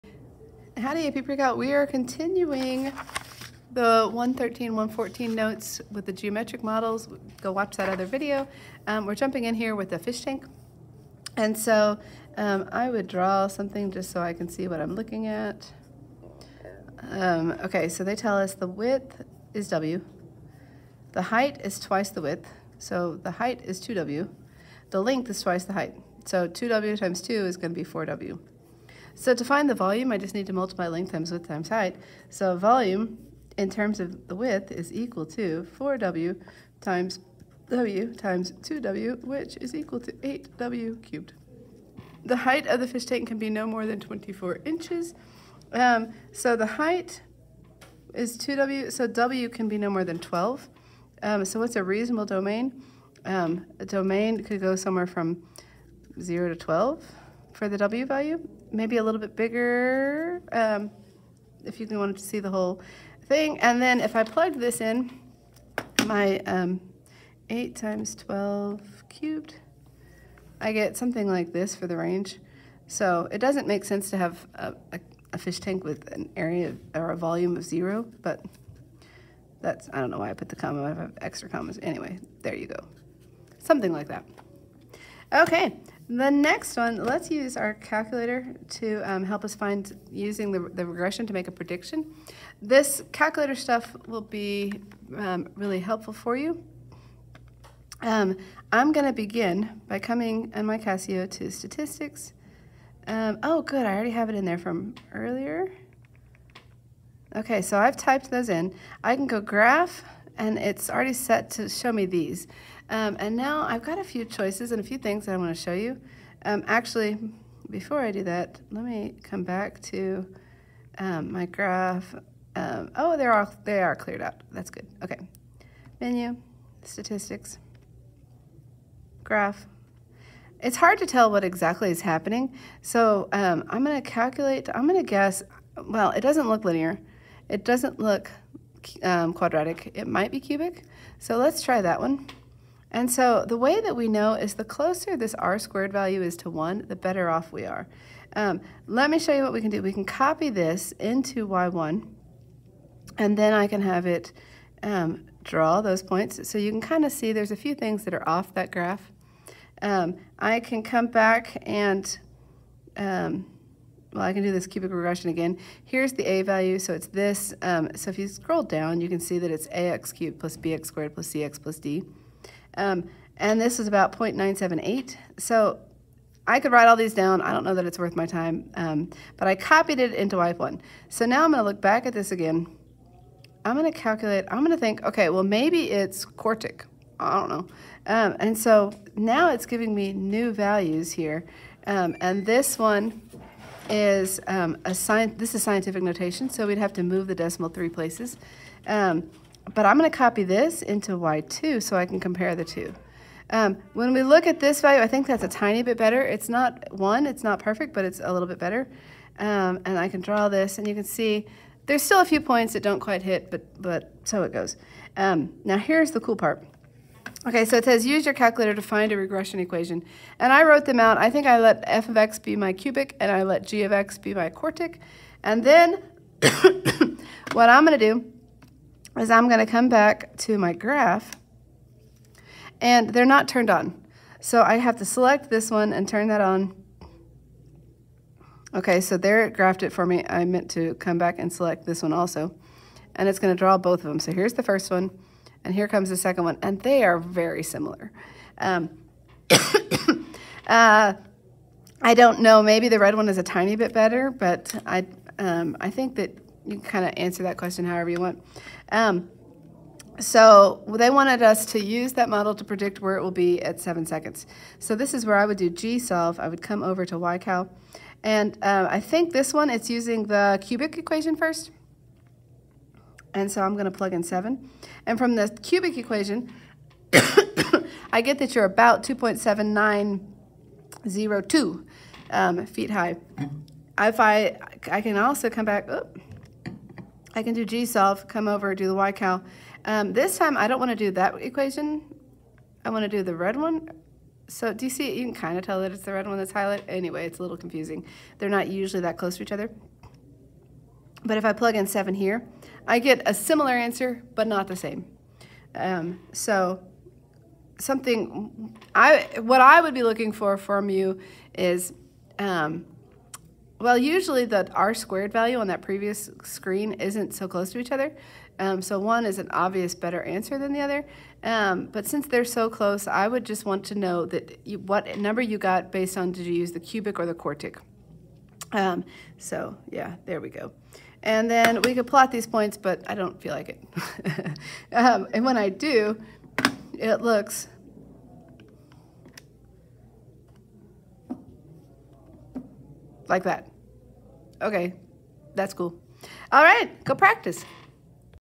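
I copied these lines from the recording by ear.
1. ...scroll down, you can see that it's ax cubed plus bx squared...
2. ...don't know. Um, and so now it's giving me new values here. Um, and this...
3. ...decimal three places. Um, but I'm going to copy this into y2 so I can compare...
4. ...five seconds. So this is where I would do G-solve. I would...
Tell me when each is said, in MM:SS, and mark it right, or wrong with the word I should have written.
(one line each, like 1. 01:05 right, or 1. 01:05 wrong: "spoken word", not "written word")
1. 02:48 right
2. 03:07 right
3. 03:17 right
4. 04:23 wrong: "seven", not "five".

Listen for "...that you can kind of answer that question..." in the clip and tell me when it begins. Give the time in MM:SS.
04:16.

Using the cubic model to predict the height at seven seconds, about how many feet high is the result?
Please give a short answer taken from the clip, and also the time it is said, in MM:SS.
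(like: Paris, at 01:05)
2.7902, at 04:39.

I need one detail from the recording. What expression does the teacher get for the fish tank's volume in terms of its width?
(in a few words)
8w cubed.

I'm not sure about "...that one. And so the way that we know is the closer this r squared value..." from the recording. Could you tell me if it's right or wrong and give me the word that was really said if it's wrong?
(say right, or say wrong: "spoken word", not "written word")
right.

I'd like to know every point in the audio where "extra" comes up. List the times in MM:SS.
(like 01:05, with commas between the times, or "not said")
01:21.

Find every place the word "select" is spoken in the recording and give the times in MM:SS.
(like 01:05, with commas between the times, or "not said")
03:55, 04:01.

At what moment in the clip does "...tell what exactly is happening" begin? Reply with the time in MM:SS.
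02:11.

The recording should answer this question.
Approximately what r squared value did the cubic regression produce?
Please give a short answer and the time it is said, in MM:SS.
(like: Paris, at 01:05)
0.978, at 02:54.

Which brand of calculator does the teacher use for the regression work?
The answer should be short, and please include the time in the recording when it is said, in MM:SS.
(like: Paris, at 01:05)
Casio, at 01:40.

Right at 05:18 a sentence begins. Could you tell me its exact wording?
Um, so one is an obvious better answer than the other.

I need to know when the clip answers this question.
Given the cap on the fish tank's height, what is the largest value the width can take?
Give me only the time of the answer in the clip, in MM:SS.
00:49.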